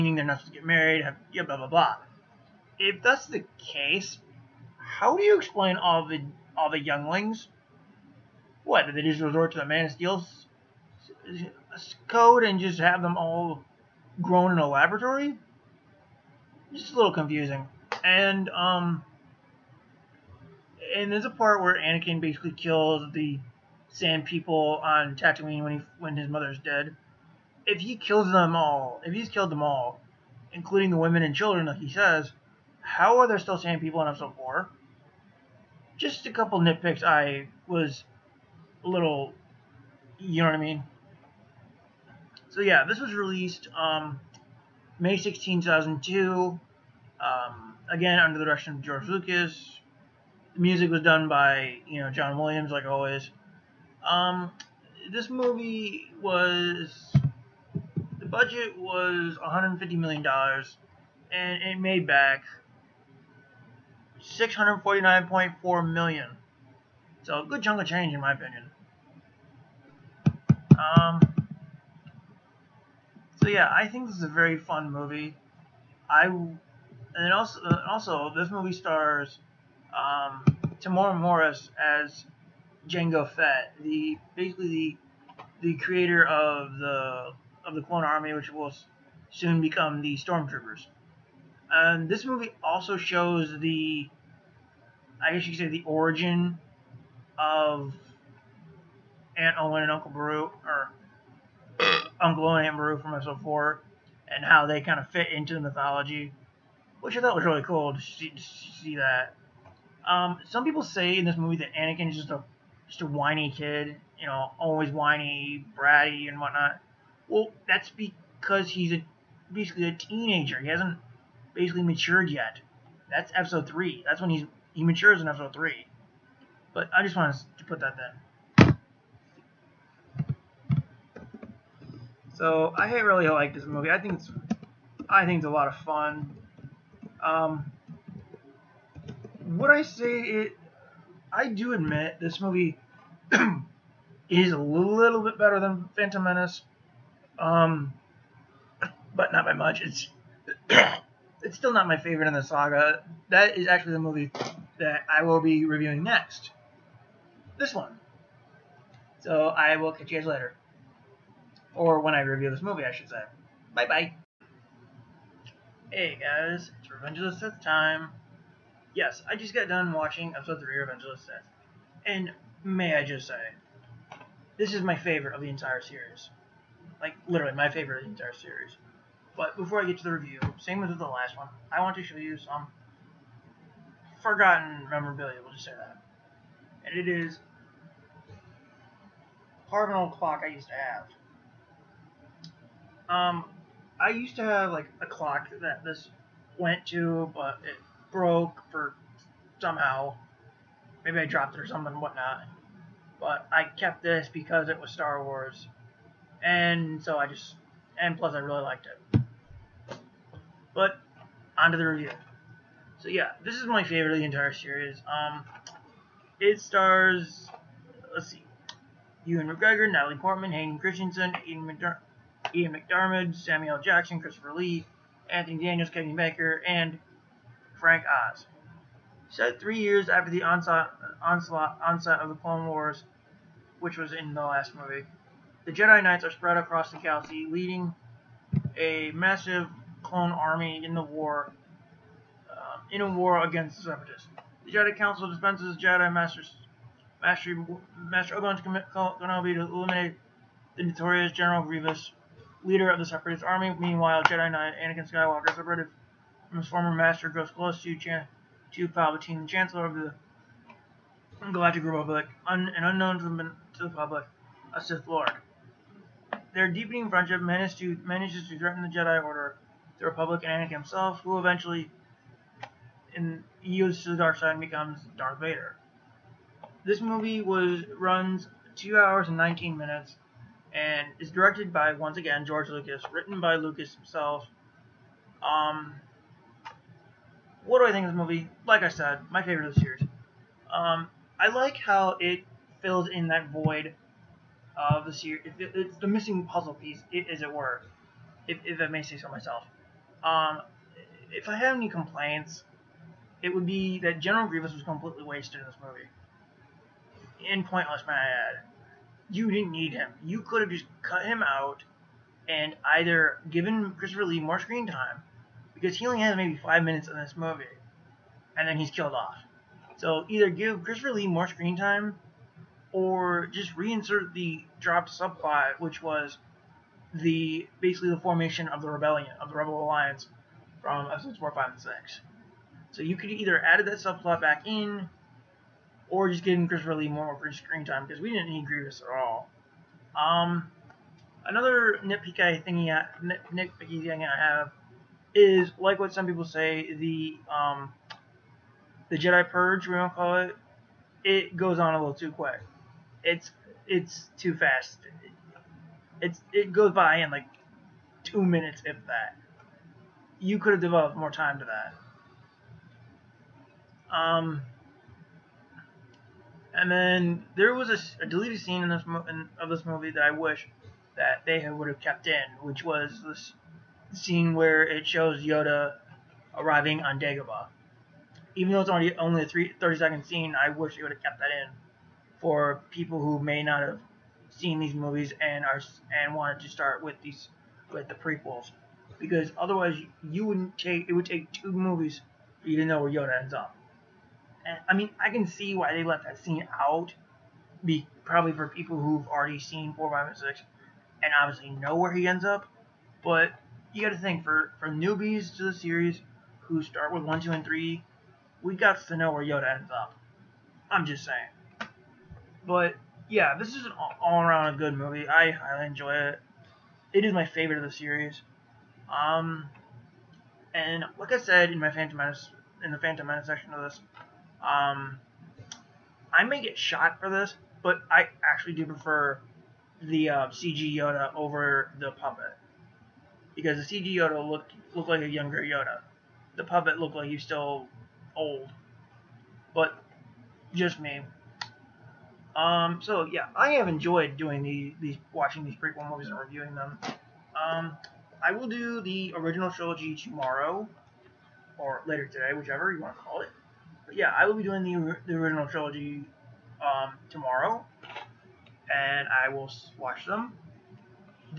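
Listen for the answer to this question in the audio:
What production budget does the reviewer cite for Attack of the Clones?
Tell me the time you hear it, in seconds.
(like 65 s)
59 s.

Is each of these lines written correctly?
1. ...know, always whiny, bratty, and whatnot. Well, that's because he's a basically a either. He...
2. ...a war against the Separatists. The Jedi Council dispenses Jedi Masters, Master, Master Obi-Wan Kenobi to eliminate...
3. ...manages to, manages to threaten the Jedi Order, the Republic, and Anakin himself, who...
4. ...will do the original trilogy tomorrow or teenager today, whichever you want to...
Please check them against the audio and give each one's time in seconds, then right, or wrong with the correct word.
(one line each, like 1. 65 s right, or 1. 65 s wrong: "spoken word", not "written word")
1. 114 s wrong: "teenager", not "either"
2. 242 s right
3. 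267 s right
4. 448 s wrong: "later", not "teenager".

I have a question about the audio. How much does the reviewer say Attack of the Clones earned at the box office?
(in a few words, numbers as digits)
$649.4 million.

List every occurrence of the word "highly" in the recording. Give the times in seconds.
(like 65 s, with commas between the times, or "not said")
415 s.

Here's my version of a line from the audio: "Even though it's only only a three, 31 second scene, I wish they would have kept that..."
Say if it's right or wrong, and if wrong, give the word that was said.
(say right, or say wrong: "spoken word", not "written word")
wrong: "30", not "31".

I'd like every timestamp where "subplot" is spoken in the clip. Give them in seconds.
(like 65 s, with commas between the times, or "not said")
325 s, 333 s.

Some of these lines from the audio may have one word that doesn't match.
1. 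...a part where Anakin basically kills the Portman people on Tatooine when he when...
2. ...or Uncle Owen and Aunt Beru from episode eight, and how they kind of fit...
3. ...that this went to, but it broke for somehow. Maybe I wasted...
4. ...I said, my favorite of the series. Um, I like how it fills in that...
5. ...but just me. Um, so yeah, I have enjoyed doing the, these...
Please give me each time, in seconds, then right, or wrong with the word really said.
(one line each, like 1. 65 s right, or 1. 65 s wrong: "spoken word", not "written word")
1. 21 s wrong: "Sand", not "Portman"
2. 100 s wrong: "four", not "eight"
3. 195 s wrong: "dropped", not "wasted"
4. 288 s right
5. 439 s right.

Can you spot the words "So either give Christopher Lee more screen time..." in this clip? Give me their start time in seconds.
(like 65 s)
319 s.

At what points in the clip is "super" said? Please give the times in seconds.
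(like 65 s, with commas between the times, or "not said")
not said.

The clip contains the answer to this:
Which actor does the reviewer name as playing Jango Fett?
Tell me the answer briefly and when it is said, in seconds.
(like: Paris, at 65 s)
Tamora Morris, at 80 s.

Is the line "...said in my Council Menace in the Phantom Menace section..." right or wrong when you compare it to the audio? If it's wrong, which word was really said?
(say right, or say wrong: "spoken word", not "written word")
wrong: "Phantom", not "Council".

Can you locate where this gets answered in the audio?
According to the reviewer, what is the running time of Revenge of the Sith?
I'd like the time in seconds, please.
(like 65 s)
278 s.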